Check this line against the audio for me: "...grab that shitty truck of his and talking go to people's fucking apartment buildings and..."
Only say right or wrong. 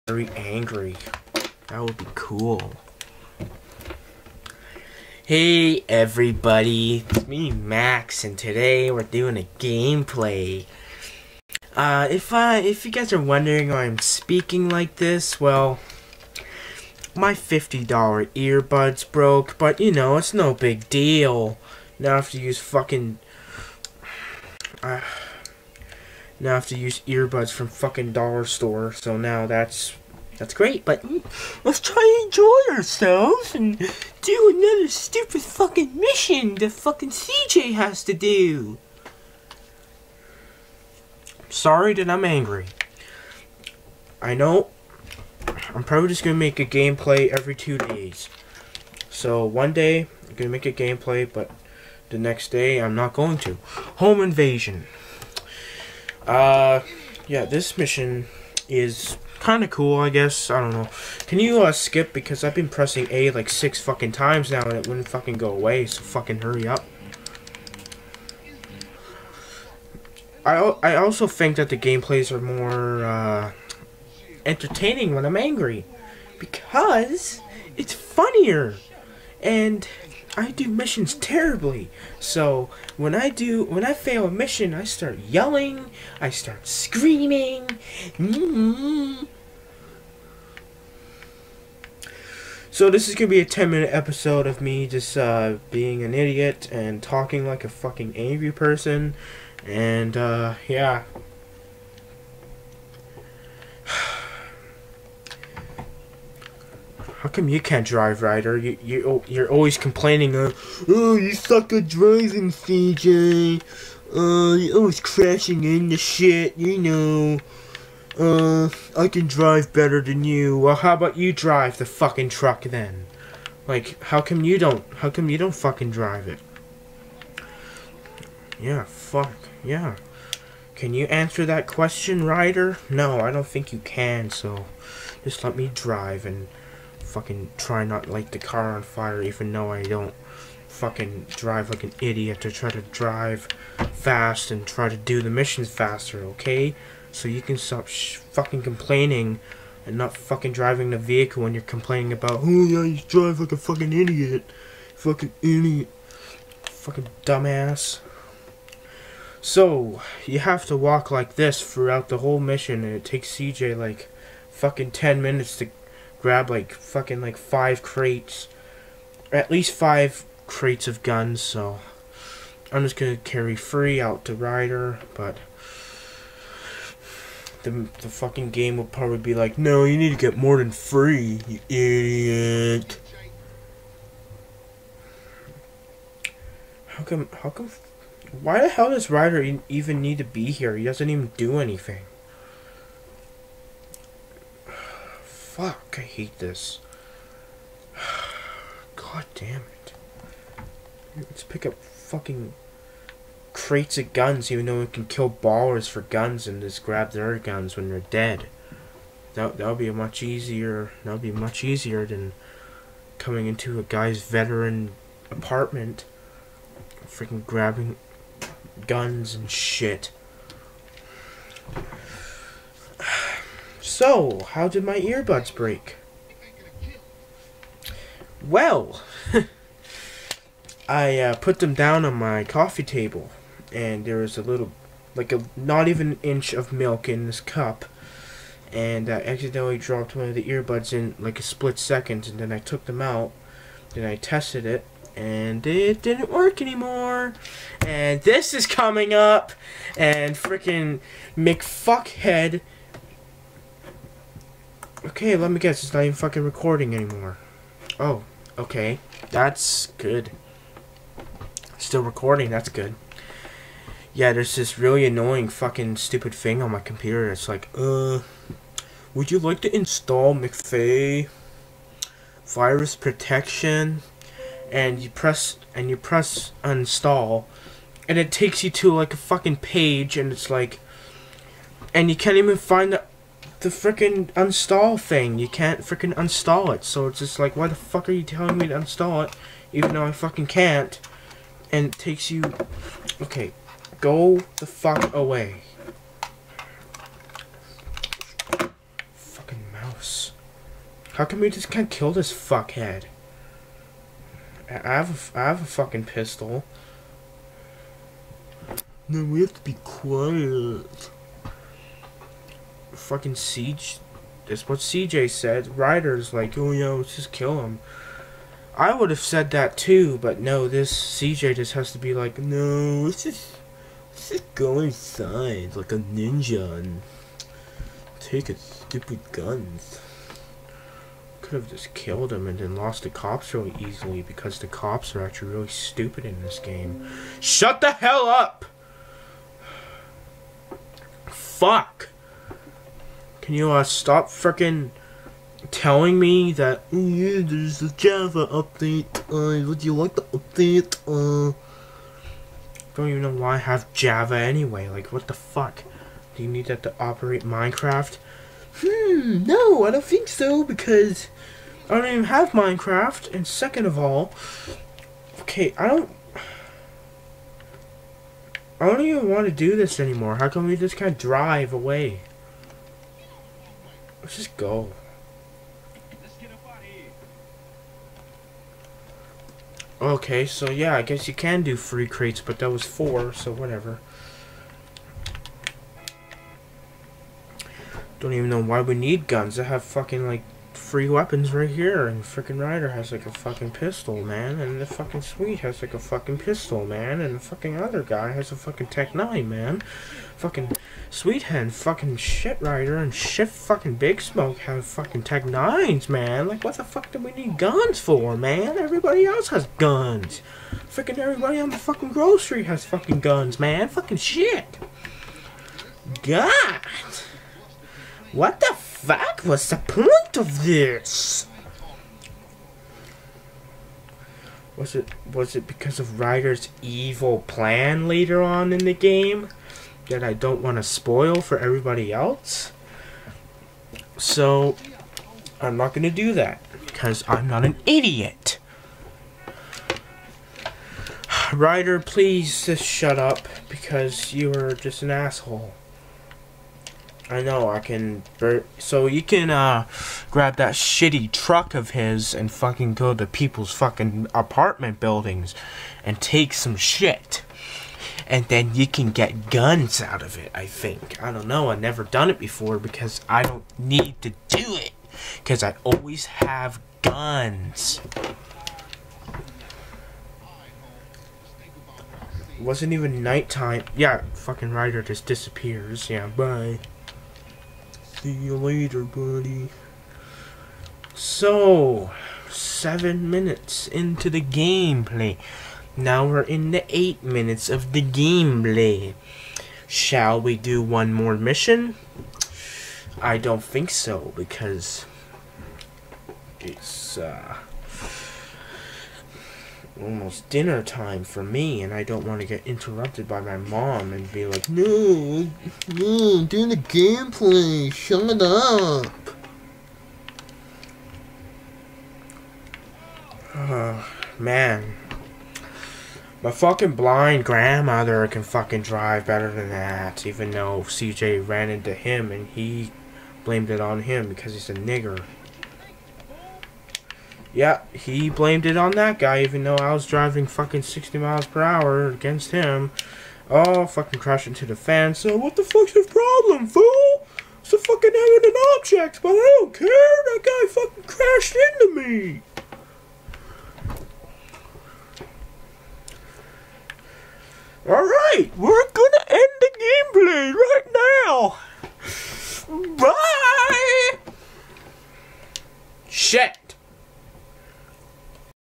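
wrong.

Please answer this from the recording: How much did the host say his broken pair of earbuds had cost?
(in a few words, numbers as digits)
$50.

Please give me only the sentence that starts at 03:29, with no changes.
That that'll be much easier that'll be much easier than coming into a guy's veteran apartment freaking grabbing guns and shit.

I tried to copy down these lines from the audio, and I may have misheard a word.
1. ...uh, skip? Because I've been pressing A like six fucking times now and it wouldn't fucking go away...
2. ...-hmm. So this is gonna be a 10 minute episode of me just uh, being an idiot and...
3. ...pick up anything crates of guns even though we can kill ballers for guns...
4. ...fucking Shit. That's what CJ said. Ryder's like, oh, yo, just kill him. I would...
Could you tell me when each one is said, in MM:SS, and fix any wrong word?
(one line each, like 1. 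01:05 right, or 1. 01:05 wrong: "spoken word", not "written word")
1. 01:01 right
2. 01:28 right
3. 03:21 wrong: "fucking", not "anything"
4. 05:13 wrong: "Siege", not "Shit".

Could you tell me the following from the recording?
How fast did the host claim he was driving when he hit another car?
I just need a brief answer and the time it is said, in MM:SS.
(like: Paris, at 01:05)
60 miles per hour, at 08:50.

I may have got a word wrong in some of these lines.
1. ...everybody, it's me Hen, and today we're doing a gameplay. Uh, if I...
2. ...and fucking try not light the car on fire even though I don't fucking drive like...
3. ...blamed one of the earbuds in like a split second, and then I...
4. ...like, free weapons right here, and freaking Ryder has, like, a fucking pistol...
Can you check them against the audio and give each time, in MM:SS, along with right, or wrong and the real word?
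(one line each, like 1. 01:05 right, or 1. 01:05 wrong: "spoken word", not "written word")
1. 00:05 wrong: "Max", not "Hen"
2. 02:16 right
3. 03:59 wrong: "dropped", not "blamed"
4. 06:30 right.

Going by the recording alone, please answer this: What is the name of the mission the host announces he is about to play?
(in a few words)
Home invasion.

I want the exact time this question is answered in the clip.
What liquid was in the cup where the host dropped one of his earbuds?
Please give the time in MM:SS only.
03:56.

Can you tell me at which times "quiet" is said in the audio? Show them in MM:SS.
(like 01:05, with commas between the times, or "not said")
05:09.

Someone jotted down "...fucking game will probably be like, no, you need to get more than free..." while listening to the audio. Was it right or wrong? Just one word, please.
right.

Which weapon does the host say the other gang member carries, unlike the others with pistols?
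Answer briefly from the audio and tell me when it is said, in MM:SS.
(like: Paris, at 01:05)
Tec-9, at 06:38.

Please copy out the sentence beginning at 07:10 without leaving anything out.
that I don't want to spoil for everybody else.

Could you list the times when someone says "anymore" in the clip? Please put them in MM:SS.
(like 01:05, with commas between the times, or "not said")
04:06, 04:16, 06:09.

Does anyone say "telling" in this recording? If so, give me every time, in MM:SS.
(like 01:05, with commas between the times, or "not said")
04:48, 05:45.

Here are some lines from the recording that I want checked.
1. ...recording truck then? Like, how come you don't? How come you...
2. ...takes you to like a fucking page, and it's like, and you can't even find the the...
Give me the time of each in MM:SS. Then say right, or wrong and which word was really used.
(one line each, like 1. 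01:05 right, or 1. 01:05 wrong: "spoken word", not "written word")
1. 02:01 wrong: "fucking", not "recording"
2. 04:38 right.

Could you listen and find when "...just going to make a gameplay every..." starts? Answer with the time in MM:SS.
00:46.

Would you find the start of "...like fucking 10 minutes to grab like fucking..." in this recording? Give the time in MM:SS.
02:43.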